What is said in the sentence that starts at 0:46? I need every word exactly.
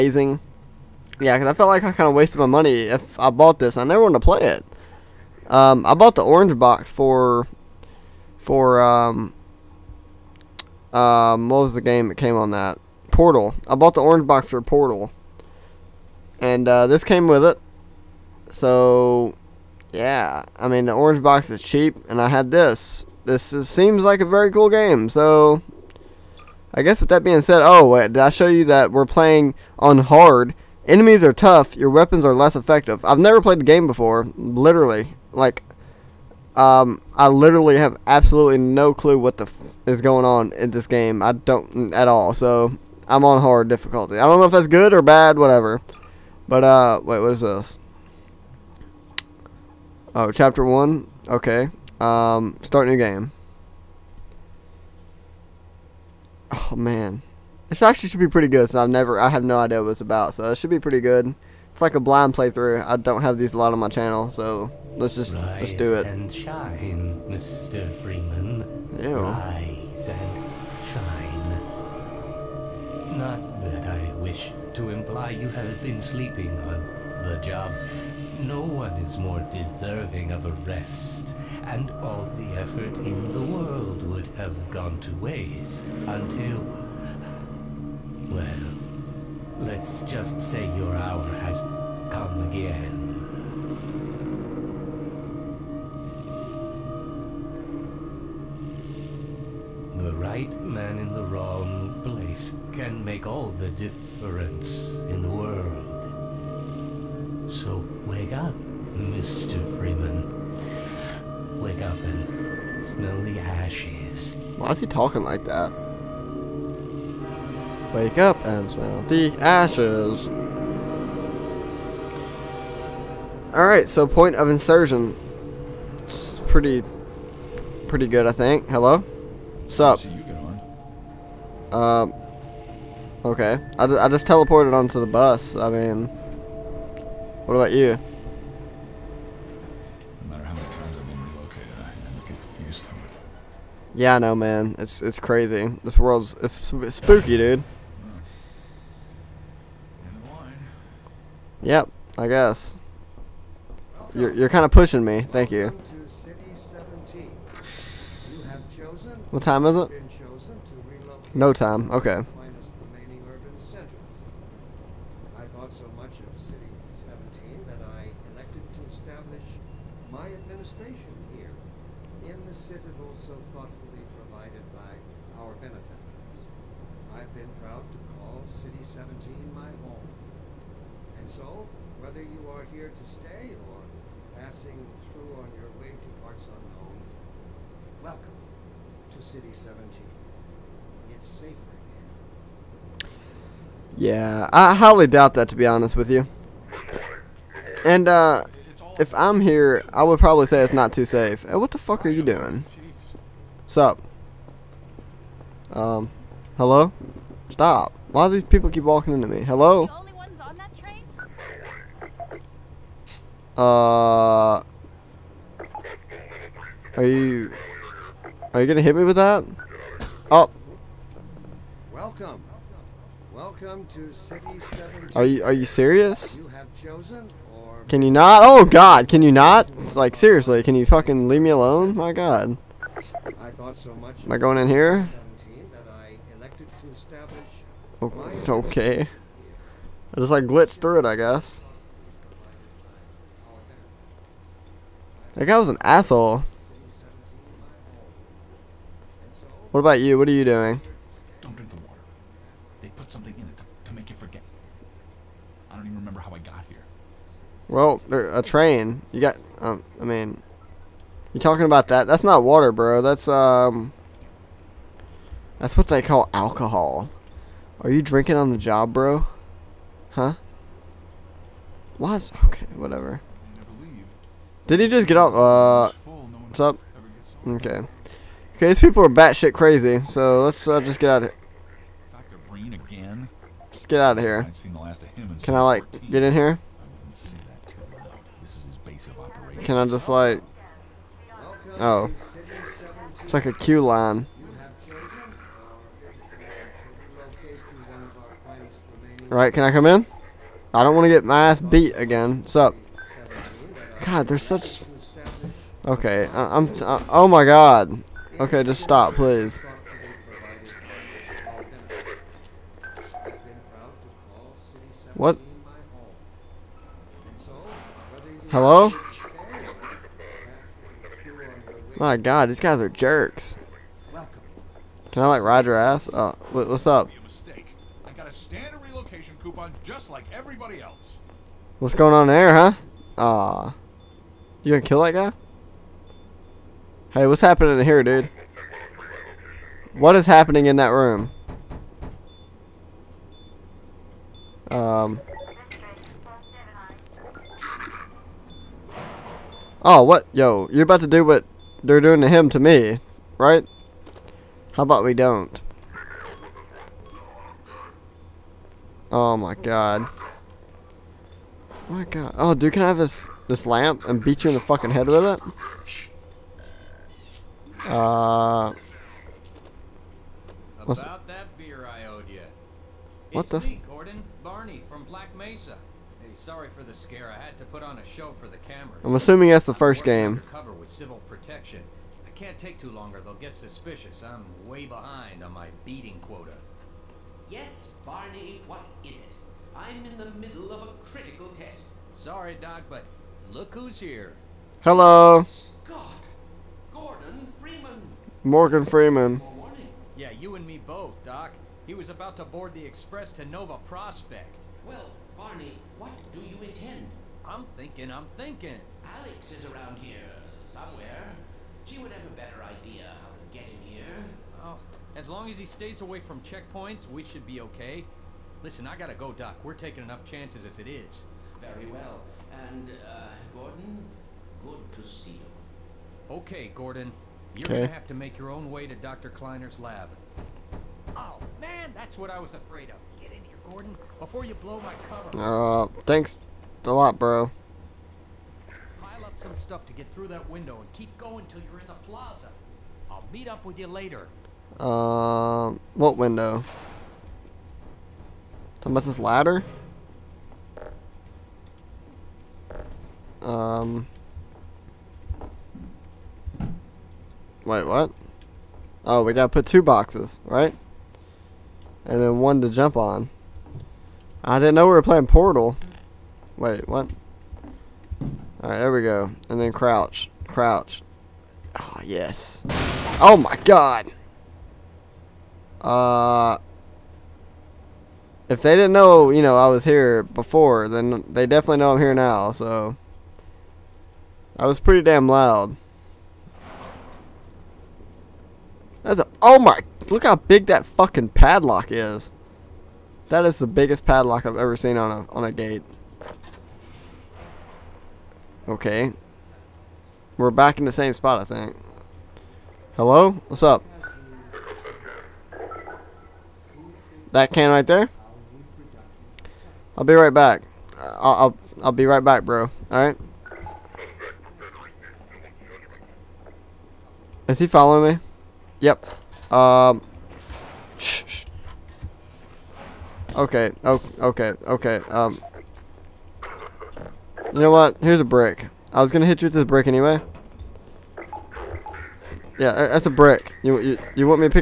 But uh, wait, what is this?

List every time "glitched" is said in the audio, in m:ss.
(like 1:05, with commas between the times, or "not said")
4:00.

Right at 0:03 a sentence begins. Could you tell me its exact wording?
I never wanted to play it.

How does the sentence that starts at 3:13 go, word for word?
Yeah, I highly doubt that to be honest with you.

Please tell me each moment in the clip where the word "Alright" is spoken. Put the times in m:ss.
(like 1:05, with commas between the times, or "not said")
2:03, 7:48, 8:32.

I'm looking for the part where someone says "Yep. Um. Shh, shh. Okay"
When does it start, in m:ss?
8:38.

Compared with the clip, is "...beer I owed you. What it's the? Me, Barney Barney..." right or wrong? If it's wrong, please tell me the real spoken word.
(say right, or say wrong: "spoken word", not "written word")
wrong: "Gordon", not "Barney".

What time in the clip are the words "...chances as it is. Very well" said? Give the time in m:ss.
7:00.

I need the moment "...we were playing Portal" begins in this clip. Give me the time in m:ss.
7:44.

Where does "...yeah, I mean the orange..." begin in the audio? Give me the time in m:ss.
0:19.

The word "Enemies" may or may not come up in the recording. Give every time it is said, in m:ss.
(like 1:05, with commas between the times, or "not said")
0:30.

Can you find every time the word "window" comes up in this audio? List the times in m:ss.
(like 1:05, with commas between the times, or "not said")
7:20, 7:26.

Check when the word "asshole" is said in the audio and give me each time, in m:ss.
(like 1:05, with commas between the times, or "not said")
4:05.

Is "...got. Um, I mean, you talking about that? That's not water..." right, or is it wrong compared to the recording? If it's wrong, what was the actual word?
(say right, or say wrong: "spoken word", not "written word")
right.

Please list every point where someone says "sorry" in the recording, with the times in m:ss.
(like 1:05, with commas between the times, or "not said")
6:16, 6:32.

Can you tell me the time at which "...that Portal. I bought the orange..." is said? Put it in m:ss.
0:12.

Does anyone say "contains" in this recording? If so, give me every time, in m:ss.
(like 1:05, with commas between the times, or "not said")
not said.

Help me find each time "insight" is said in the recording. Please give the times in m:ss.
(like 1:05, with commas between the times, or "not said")
not said.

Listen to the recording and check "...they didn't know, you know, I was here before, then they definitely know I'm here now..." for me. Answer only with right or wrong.
right.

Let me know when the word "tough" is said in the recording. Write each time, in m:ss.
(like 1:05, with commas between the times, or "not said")
0:31.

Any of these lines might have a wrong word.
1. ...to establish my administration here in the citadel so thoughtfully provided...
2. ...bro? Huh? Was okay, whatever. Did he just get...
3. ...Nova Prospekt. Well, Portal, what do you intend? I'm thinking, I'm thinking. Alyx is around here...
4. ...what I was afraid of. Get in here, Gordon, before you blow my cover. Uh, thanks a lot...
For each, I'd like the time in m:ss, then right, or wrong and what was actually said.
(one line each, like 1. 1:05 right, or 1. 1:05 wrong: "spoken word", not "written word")
1. 2:48 right
2. 4:28 right
3. 6:43 wrong: "Barney", not "Portal"
4. 7:12 right.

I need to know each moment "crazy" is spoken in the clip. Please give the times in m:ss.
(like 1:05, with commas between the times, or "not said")
2:25, 4:39.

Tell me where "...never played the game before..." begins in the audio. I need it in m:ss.
0:33.